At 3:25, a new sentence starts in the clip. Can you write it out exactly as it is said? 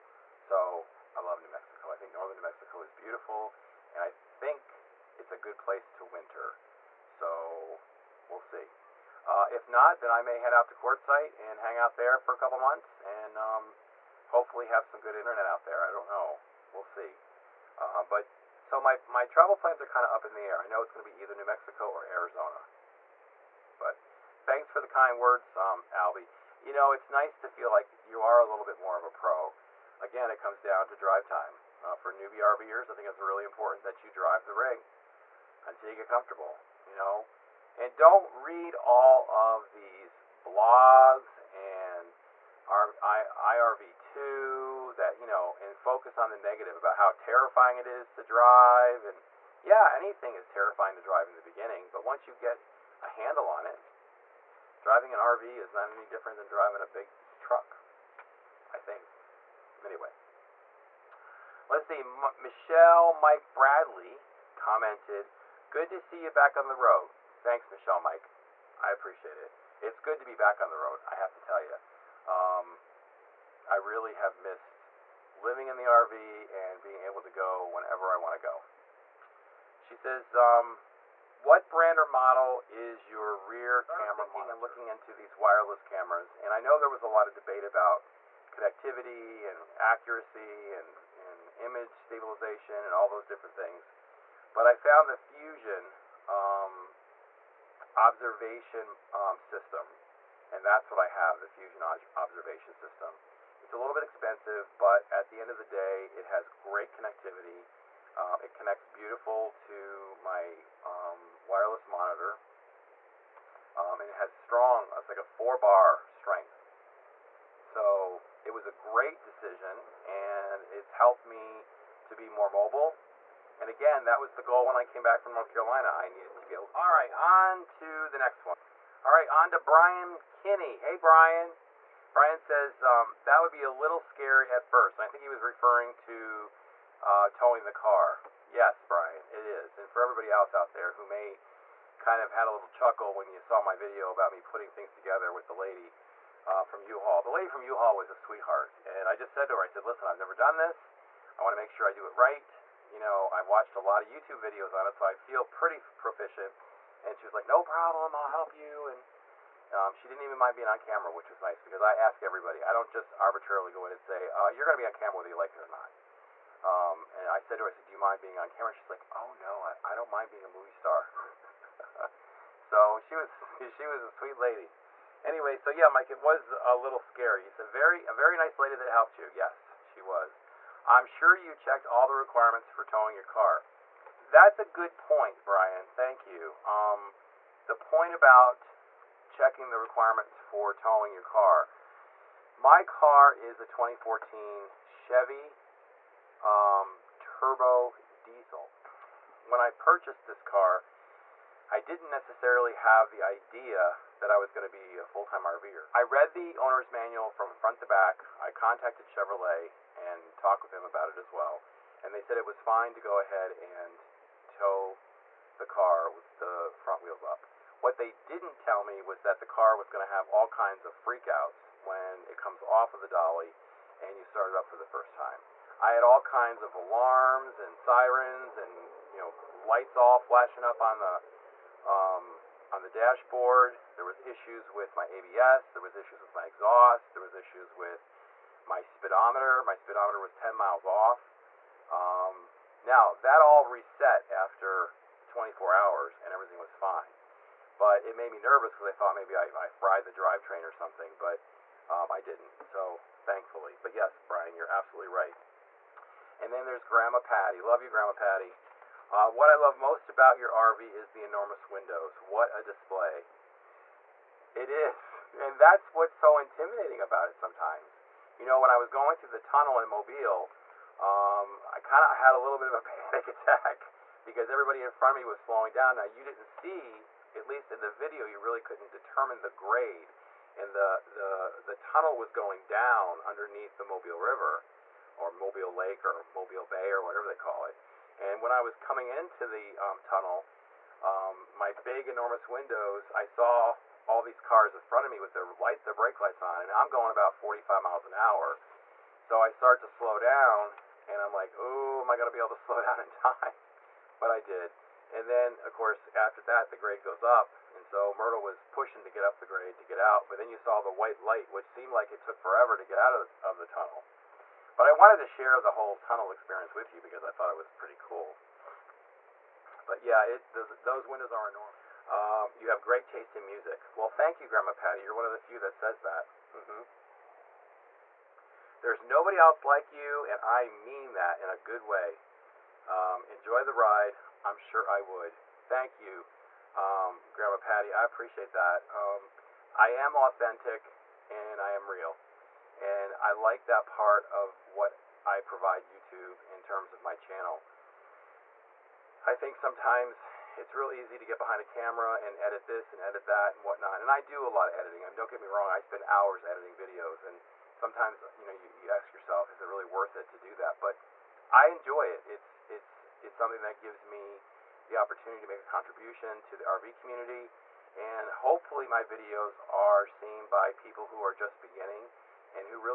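I read the owner's manual from front to back.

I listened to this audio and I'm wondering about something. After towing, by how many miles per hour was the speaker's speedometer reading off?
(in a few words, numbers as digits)
10.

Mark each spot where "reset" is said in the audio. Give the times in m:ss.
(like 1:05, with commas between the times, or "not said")
4:03.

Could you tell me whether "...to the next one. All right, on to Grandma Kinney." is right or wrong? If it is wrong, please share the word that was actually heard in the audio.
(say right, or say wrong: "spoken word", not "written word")
wrong: "Brian", not "Grandma".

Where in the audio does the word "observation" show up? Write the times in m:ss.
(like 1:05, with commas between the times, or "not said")
1:37, 1:42.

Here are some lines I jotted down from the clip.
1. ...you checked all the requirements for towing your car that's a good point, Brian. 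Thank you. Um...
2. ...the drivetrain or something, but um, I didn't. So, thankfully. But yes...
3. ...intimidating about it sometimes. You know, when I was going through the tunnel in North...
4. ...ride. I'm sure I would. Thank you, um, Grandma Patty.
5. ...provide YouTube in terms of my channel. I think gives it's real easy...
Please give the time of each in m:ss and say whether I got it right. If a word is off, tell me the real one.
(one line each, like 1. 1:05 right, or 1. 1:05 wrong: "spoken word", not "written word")
1. 3:01 right
2. 4:10 right
3. 4:26 wrong: "Mobile", not "North"
4. 5:33 right
5. 5:45 wrong: "sometimes", not "gives".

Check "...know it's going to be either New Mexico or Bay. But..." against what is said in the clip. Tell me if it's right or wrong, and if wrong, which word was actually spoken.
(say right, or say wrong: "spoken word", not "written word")
wrong: "Arizona", not "Bay".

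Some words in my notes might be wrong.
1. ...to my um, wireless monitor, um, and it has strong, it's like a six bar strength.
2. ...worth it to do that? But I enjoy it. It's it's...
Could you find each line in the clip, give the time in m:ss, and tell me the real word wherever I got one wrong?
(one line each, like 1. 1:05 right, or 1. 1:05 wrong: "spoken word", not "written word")
1. 1:49 wrong: "four", not "six"
2. 5:59 right.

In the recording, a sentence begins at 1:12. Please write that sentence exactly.
Um, I really have missed living in the RV and being able to go whenever I want to go.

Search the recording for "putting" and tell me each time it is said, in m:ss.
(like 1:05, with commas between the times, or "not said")
2:24.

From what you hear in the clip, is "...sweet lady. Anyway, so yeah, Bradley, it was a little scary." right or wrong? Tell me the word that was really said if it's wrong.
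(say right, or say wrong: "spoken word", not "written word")
wrong: "Mike", not "Bradley".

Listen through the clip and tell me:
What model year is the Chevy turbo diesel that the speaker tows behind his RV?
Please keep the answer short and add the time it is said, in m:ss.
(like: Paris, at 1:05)
2014, at 3:13.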